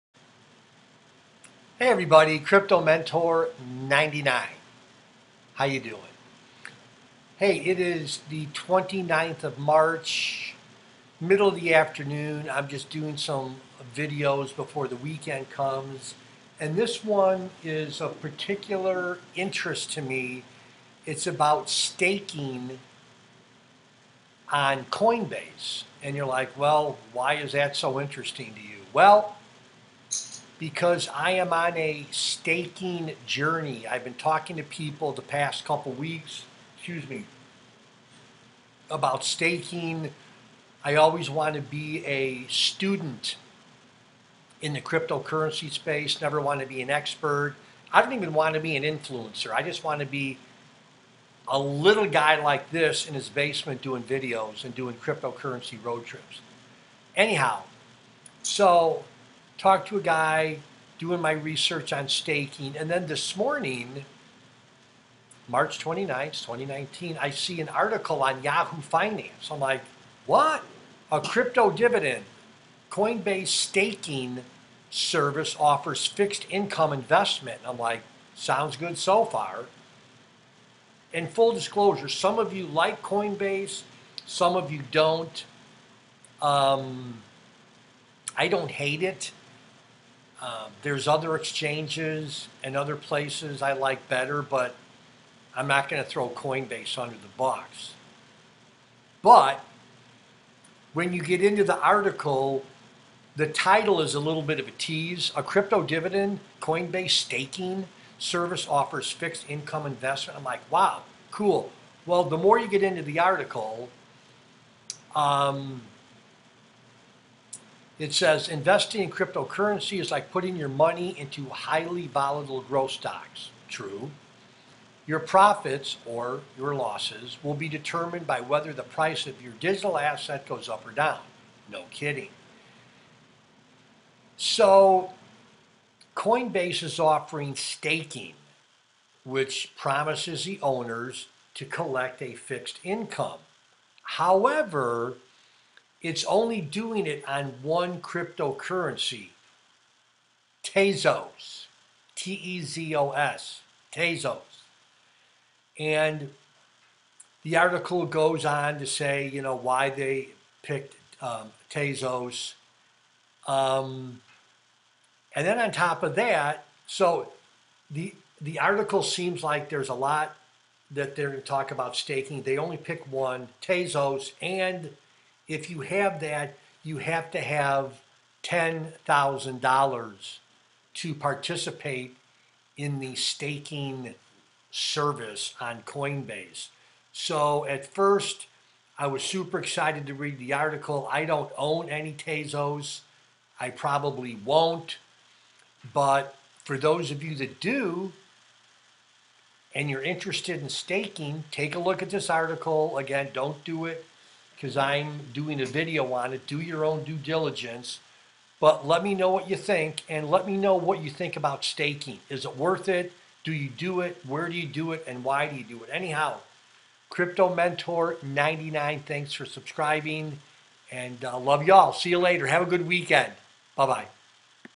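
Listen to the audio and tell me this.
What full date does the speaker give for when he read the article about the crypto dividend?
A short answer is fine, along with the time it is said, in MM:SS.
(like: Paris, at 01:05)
March 29th, 2019, at 01:05.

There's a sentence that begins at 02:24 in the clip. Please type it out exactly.
However, it's only doing it on one cryptocurrency, Tezos, T E Z O S, Tezos.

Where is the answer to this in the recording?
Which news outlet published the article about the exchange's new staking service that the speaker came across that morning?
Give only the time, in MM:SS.
01:08.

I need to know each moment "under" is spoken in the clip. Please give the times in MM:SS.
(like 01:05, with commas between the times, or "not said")
01:36.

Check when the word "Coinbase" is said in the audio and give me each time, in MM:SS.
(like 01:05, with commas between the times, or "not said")
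00:24, 01:12, 01:23, 01:36, 01:46, 02:16, 03:05.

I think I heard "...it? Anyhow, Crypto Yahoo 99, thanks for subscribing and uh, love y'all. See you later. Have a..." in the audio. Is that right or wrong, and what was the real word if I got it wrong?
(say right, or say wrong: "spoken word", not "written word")
wrong: "Mentor", not "Yahoo".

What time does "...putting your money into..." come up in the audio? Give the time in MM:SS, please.
02:00.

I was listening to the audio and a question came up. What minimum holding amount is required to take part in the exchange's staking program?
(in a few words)
$10,000.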